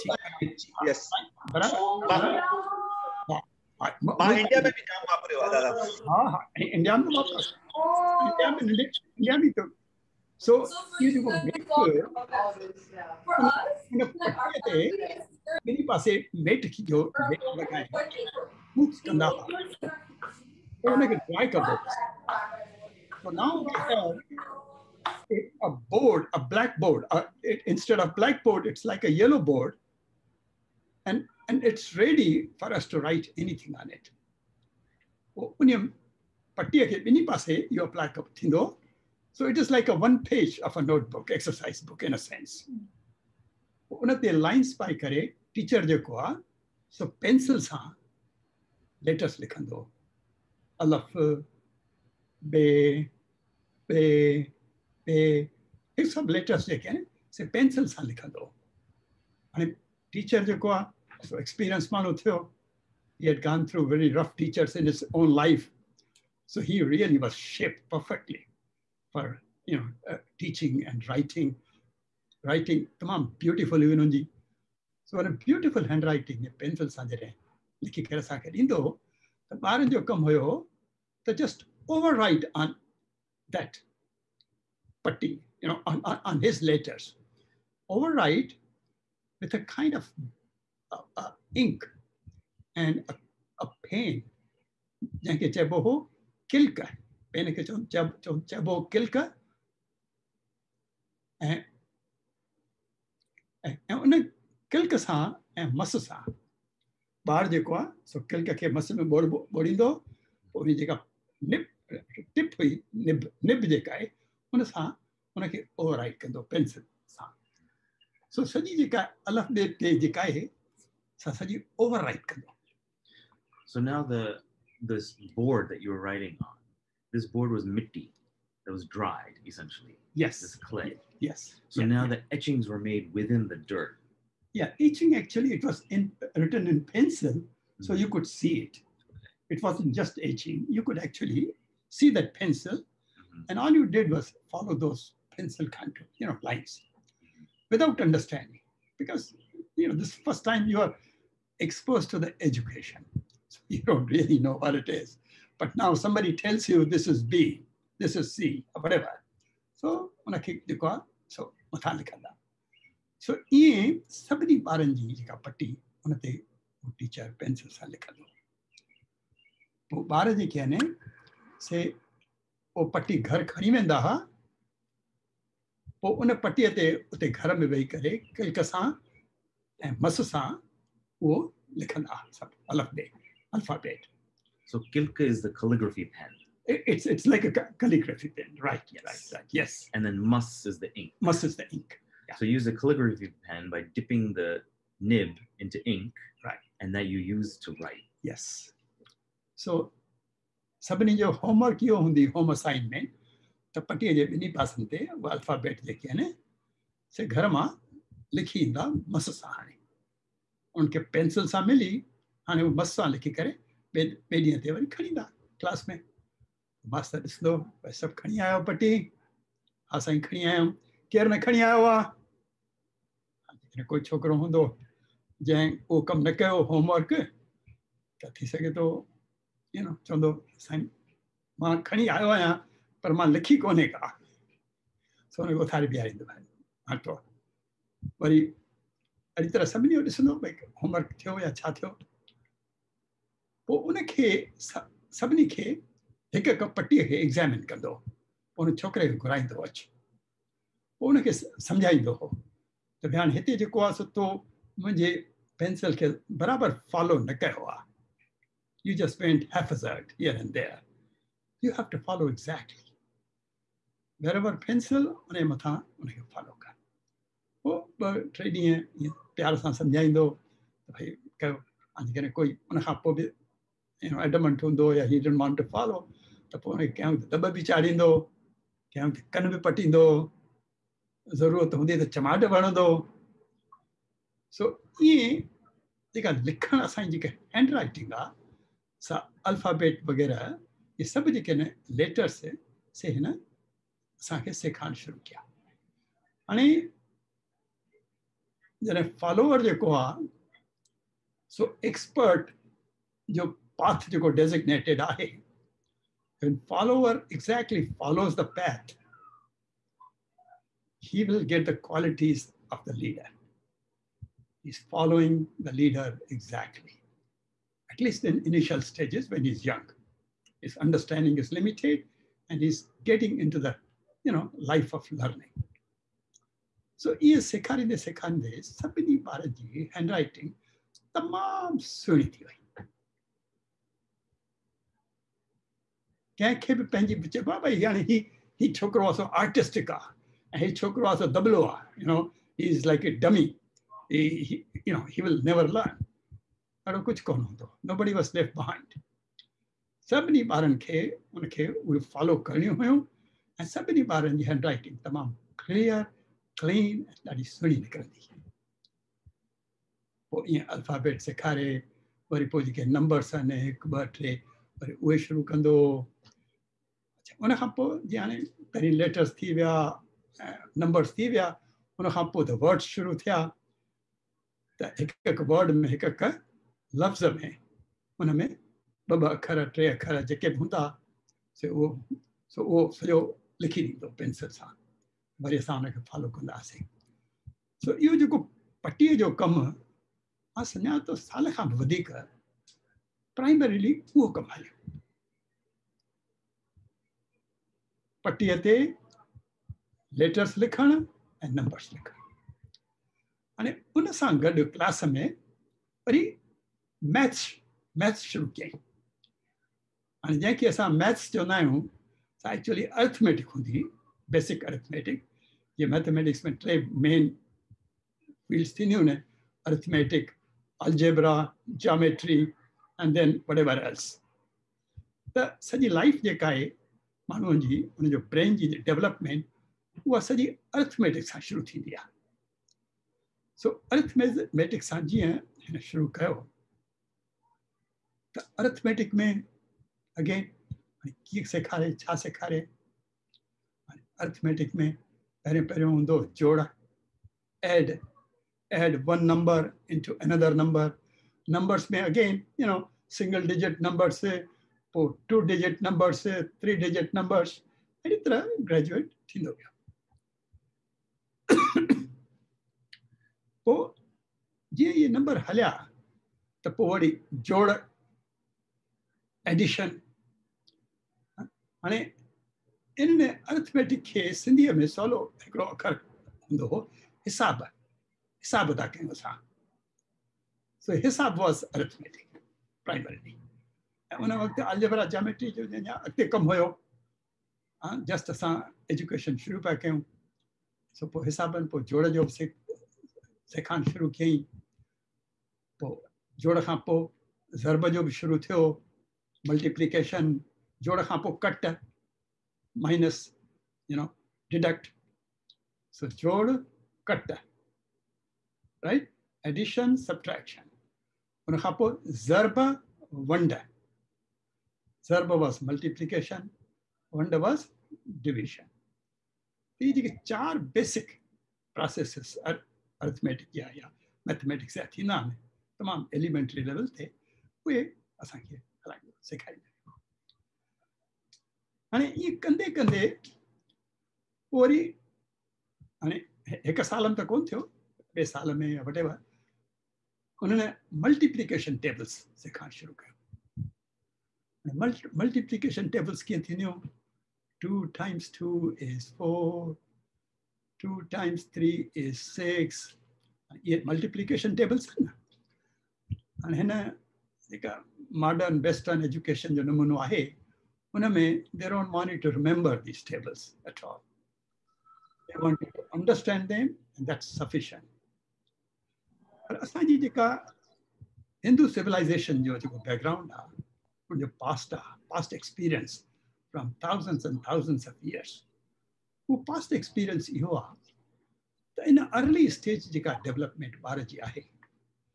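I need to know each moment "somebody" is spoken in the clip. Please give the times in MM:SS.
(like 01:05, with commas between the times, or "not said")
02:35, 02:44.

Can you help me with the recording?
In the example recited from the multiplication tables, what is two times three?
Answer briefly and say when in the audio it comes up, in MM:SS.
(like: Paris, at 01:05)
6, at 09:12.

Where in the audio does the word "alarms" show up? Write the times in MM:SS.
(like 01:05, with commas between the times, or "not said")
not said.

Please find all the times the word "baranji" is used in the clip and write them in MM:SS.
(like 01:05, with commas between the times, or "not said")
02:44, 02:50.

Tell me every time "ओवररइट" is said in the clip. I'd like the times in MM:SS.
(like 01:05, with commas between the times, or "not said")
02:01.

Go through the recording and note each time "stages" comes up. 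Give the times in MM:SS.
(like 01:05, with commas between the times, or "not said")
05:18, 09:42.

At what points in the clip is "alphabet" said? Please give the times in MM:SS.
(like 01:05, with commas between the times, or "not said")
03:03, 03:24.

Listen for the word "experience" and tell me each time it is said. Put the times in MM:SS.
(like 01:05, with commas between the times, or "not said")
09:35, 09:39.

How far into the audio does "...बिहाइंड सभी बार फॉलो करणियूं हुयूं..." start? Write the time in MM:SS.
05:48.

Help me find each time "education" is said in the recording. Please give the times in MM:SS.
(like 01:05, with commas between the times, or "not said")
02:32, 09:19.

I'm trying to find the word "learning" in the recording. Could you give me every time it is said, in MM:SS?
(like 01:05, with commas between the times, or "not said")
05:25.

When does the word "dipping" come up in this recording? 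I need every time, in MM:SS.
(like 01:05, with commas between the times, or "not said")
03:13.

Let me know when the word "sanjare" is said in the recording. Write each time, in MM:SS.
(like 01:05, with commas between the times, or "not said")
01:16.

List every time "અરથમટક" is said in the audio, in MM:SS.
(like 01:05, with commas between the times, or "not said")
07:53, 08:01.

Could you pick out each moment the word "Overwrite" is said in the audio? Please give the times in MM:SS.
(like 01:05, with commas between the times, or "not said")
01:27.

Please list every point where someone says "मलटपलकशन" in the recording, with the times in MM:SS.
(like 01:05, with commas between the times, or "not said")
08:19, 09:01.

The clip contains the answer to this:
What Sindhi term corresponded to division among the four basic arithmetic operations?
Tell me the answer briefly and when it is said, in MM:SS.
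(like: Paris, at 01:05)
Vanda, at 08:37.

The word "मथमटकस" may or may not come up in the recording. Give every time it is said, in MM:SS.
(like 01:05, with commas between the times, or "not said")
06:55, 08:44.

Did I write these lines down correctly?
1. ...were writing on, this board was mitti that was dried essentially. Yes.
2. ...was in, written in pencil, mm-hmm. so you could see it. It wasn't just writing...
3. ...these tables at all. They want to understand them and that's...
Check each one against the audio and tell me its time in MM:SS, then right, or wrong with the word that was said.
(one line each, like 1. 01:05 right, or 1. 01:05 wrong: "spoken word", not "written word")
1. 02:05 right
2. 02:15 wrong: "etching", not "writing"
3. 09:22 right.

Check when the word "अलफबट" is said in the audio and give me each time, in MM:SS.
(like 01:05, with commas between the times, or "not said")
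03:25, 04:49, 06:00.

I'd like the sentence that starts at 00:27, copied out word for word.
it, instead of blackboard, it's like a yellow board.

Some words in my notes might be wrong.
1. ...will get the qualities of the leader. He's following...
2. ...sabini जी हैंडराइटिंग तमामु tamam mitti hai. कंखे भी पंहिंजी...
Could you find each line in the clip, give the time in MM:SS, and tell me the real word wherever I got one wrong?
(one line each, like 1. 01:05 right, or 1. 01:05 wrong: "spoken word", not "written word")
1. 05:11 right
2. 05:29 wrong: "suniti", not "mitti".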